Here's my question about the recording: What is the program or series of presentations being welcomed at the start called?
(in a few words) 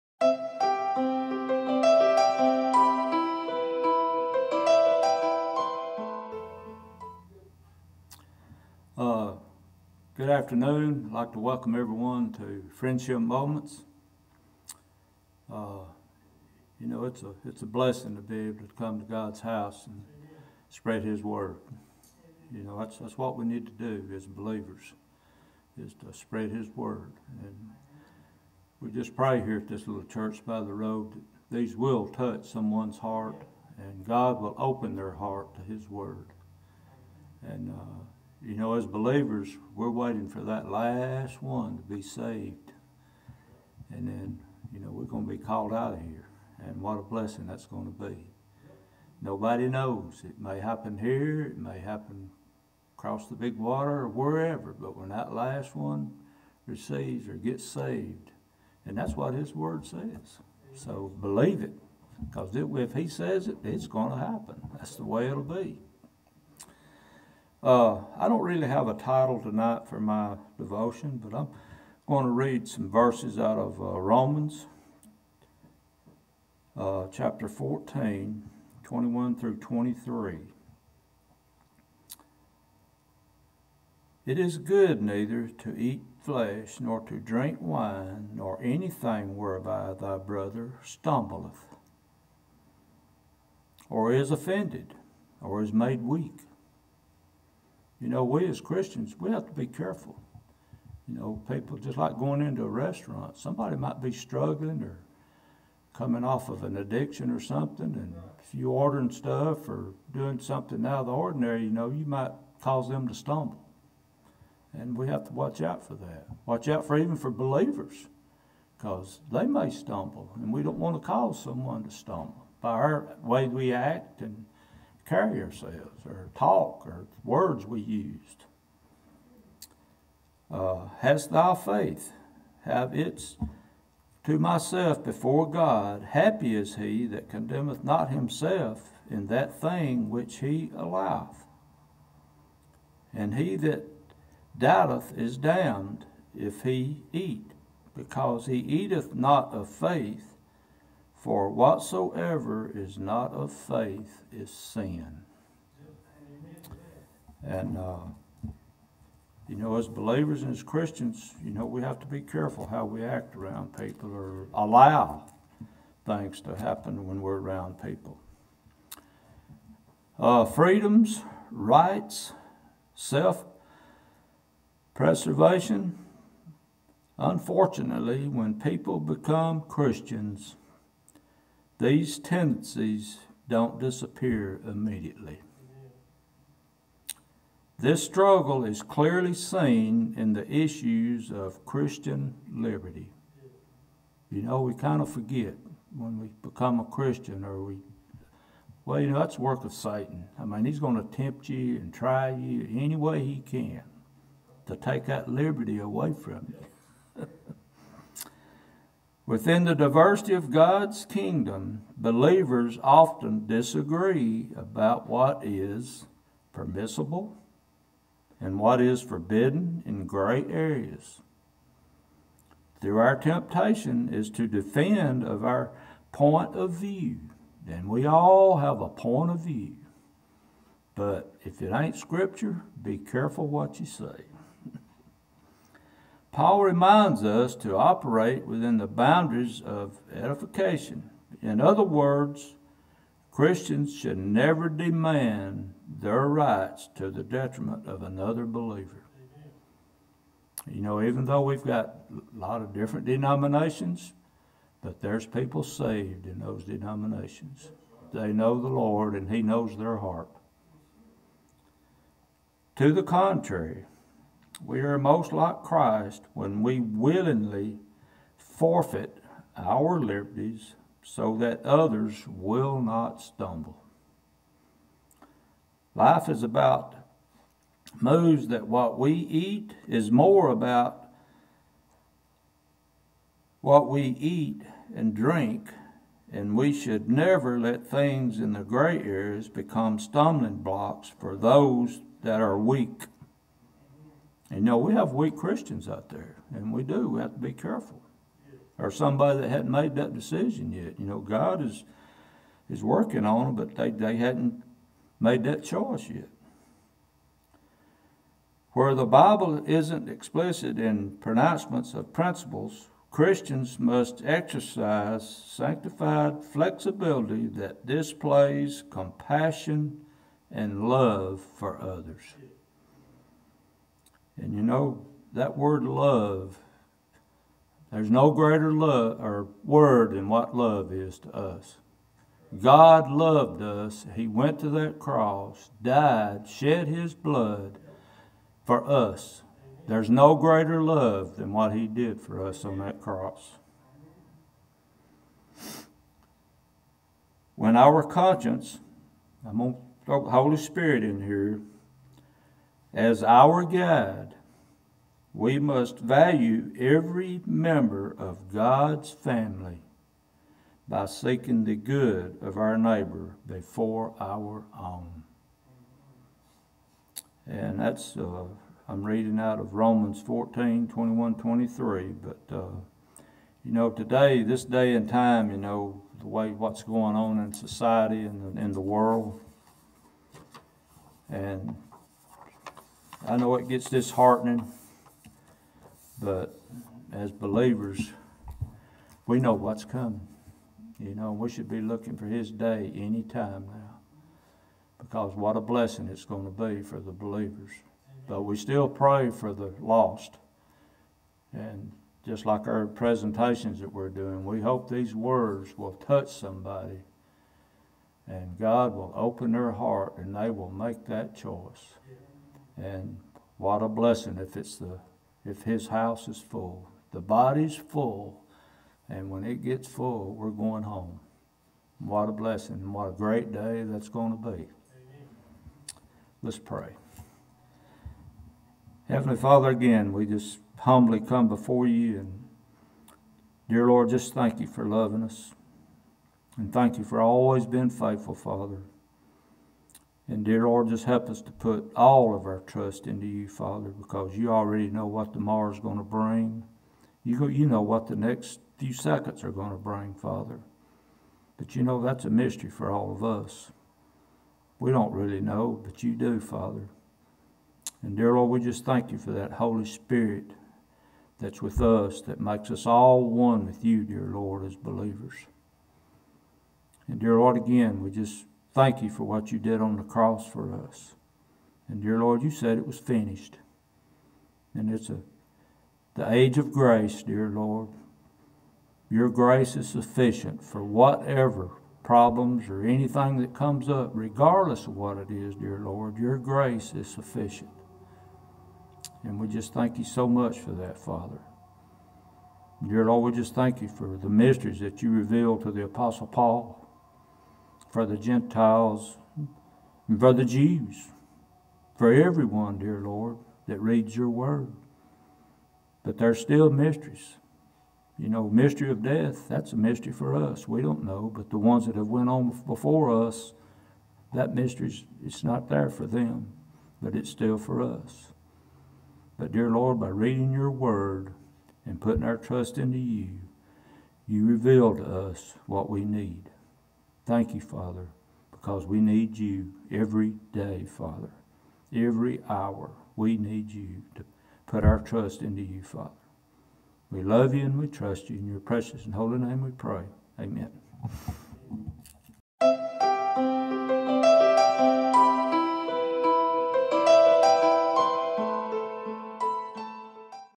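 Friendship Moments.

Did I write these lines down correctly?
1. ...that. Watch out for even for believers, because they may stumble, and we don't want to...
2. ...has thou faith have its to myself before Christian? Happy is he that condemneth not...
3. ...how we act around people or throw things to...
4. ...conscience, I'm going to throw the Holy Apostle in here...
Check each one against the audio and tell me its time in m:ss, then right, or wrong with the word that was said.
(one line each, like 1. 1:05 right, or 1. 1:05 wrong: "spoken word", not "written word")
1. 1:55 right
2. 2:10 wrong: "God", not "Christian"
3. 2:42 wrong: "allow", not "throw"
4. 5:48 wrong: "Spirit", not "Apostle".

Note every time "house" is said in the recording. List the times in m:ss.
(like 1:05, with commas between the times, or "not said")
0:19, 6:55.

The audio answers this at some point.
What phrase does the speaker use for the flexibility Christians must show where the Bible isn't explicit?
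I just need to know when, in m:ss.
5:15.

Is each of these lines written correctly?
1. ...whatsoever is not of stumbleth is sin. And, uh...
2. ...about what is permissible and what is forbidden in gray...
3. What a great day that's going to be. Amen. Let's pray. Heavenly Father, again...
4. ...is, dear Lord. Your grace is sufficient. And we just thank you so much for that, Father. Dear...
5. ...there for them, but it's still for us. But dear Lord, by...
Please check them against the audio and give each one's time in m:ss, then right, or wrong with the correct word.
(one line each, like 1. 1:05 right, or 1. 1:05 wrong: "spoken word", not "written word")
1. 2:31 wrong: "faith", not "stumbleth"
2. 3:34 right
3. 7:02 right
4. 8:05 right
5. 8:35 right.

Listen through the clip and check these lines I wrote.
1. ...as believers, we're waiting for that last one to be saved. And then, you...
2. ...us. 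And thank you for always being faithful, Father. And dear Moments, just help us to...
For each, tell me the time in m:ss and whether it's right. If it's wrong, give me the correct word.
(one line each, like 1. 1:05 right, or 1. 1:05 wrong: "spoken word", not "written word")
1. 0:38 right
2. 7:15 wrong: "Lord", not "Moments".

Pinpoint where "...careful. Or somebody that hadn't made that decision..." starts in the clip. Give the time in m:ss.
4:57.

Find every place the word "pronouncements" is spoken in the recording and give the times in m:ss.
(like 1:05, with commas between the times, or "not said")
5:11.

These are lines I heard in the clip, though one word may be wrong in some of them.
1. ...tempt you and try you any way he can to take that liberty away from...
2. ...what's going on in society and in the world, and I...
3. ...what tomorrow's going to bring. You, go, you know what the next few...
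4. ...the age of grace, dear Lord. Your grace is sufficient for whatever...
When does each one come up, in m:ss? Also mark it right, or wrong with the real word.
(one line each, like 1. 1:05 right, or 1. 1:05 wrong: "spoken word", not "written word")
1. 3:21 right
2. 6:16 right
3. 7:25 right
4. 7:56 right.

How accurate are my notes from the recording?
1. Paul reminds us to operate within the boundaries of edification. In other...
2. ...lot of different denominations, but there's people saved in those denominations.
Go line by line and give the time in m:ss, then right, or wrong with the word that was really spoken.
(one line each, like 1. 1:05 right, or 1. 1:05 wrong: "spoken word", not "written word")
1. 3:56 right
2. 4:12 right.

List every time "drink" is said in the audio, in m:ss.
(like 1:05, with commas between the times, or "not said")
1:27, 4:45.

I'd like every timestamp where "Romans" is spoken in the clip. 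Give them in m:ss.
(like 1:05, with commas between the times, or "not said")
1:14, 6:09.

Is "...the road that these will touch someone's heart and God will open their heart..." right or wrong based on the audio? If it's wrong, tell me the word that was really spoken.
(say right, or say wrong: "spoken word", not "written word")
right.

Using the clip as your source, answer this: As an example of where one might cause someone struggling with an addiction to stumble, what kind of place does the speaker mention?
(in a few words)
A restaurant.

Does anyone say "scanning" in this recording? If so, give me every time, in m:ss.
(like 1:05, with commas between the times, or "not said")
not said.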